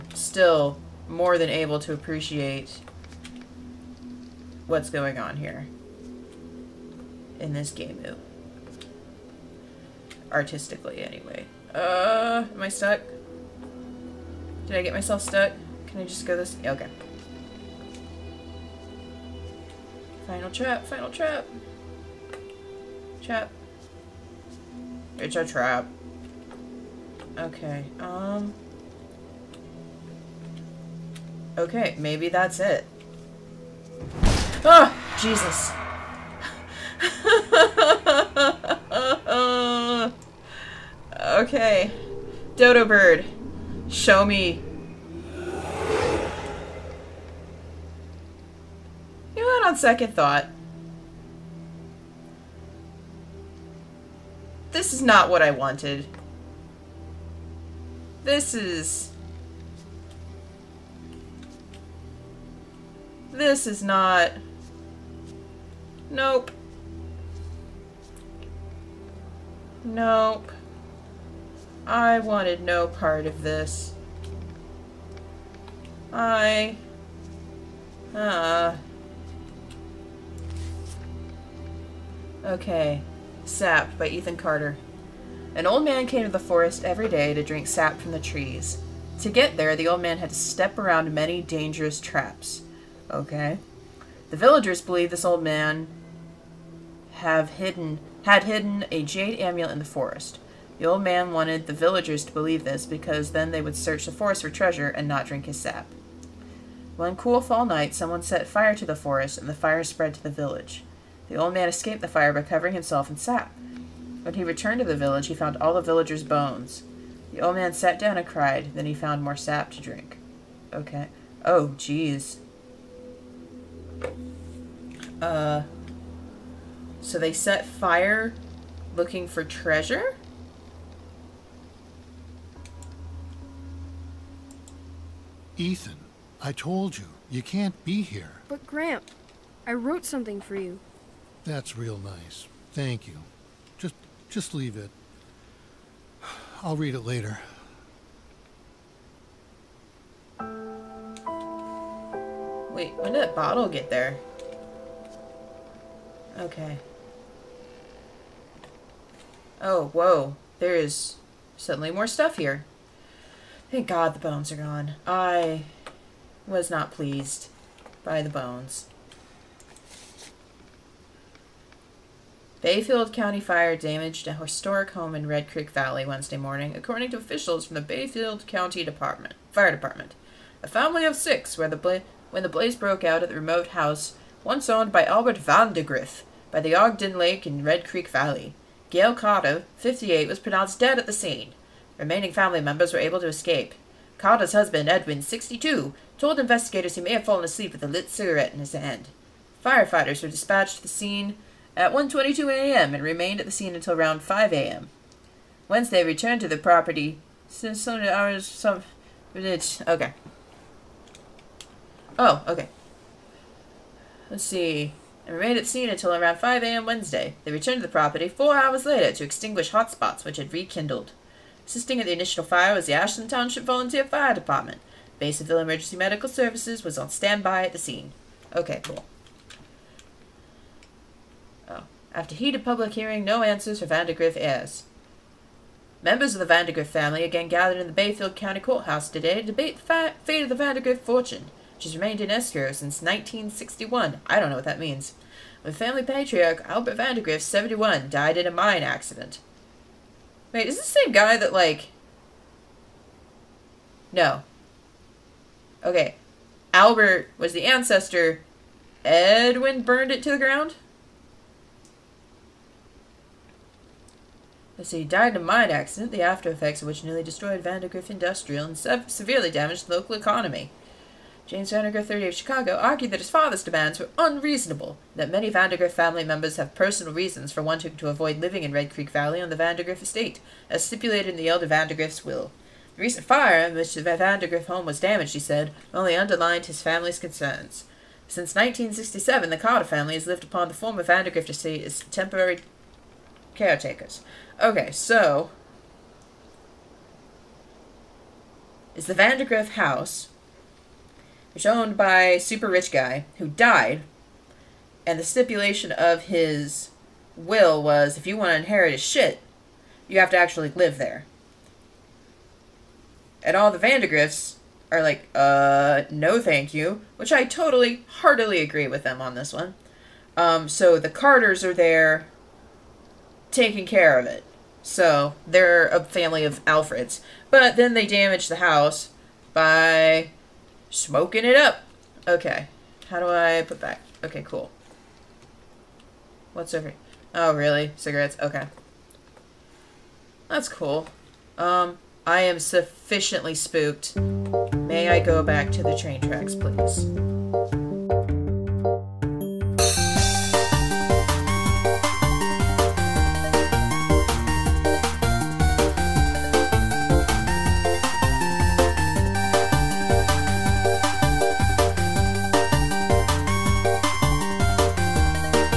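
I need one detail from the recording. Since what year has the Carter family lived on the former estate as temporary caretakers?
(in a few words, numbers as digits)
1967.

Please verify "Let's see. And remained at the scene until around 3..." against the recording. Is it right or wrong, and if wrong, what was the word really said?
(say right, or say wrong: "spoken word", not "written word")
wrong: "5", not "3".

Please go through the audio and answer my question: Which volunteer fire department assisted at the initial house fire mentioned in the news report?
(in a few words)
Ashland Township.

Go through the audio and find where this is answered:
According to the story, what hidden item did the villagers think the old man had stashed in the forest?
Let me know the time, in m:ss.
1:39.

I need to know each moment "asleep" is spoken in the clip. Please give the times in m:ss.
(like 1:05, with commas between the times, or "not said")
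3:17.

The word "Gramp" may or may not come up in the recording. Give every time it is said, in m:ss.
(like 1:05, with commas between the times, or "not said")
2:18.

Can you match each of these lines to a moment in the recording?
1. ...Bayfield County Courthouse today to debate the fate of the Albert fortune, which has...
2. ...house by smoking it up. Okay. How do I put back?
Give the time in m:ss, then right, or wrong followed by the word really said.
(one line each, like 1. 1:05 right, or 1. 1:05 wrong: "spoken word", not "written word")
1. 3:57 wrong: "Vandergriff", not "Albert"
2. 5:28 right.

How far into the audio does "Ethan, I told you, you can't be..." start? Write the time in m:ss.
2:15.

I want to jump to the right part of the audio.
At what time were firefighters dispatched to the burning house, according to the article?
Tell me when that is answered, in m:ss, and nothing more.
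3:21.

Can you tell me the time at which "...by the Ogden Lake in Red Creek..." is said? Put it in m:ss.
3:06.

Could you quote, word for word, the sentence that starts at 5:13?
And all the Vandergriffs are like, uh, no thank you, which I totally, heartily agree with them on this one.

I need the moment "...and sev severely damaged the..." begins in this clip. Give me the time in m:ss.
4:28.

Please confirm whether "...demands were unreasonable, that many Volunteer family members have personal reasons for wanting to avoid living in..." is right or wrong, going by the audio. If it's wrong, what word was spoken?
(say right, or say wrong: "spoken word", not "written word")
wrong: "Vandergrift", not "Volunteer".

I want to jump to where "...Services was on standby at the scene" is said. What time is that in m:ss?
3:46.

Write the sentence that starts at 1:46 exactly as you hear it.
One cool fall night, someone set fire to the forest and the fire spread to the village.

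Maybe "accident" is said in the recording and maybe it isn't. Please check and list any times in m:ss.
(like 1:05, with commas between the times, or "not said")
4:08, 4:25.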